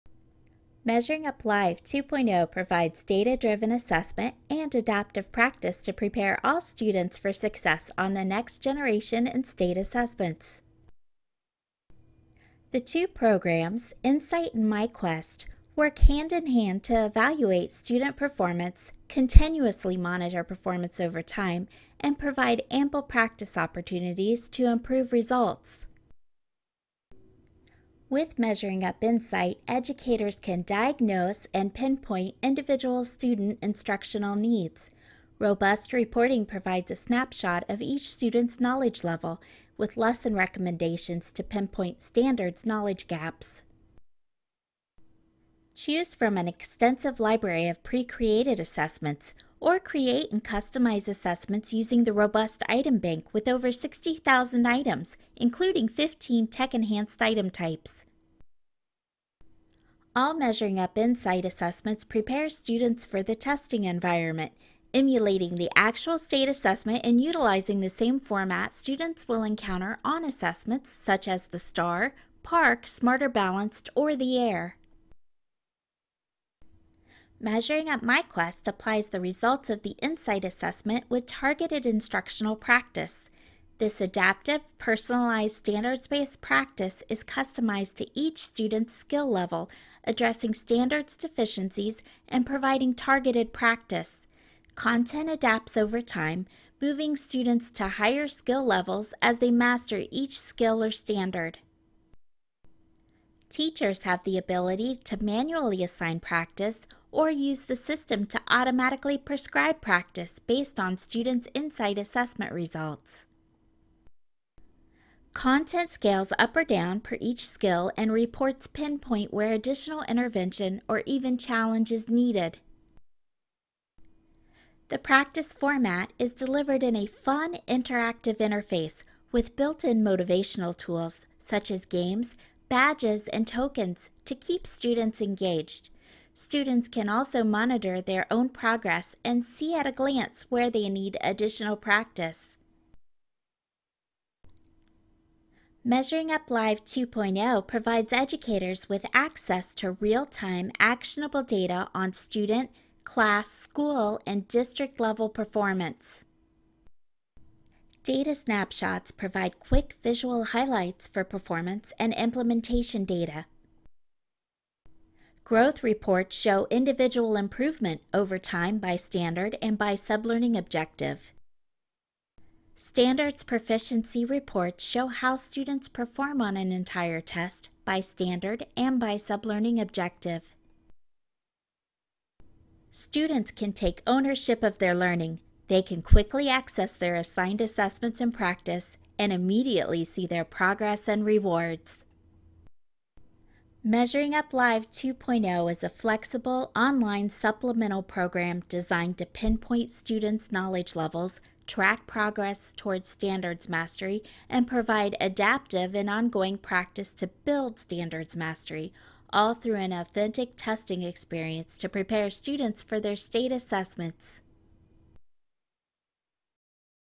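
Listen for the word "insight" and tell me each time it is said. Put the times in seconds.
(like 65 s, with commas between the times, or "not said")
14 s, 28 s, 60 s, 79 s, 111 s.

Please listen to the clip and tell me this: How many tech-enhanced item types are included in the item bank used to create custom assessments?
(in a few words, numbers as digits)
15.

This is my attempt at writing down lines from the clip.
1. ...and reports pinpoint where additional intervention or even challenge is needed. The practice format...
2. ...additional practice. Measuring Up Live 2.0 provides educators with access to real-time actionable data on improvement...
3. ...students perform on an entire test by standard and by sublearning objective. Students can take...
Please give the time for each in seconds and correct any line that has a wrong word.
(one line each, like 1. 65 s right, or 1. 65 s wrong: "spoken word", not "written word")
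1. 117 s right
2. 141 s wrong: "student", not "improvement"
3. 175 s right.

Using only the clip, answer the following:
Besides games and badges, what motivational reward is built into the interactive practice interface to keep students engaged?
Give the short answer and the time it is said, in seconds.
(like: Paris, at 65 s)
tokens, at 133 s.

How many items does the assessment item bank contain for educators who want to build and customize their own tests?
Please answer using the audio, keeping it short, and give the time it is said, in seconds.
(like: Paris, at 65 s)
over 60,000, at 53 s.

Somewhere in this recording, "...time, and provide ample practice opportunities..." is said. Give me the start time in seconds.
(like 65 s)
21 s.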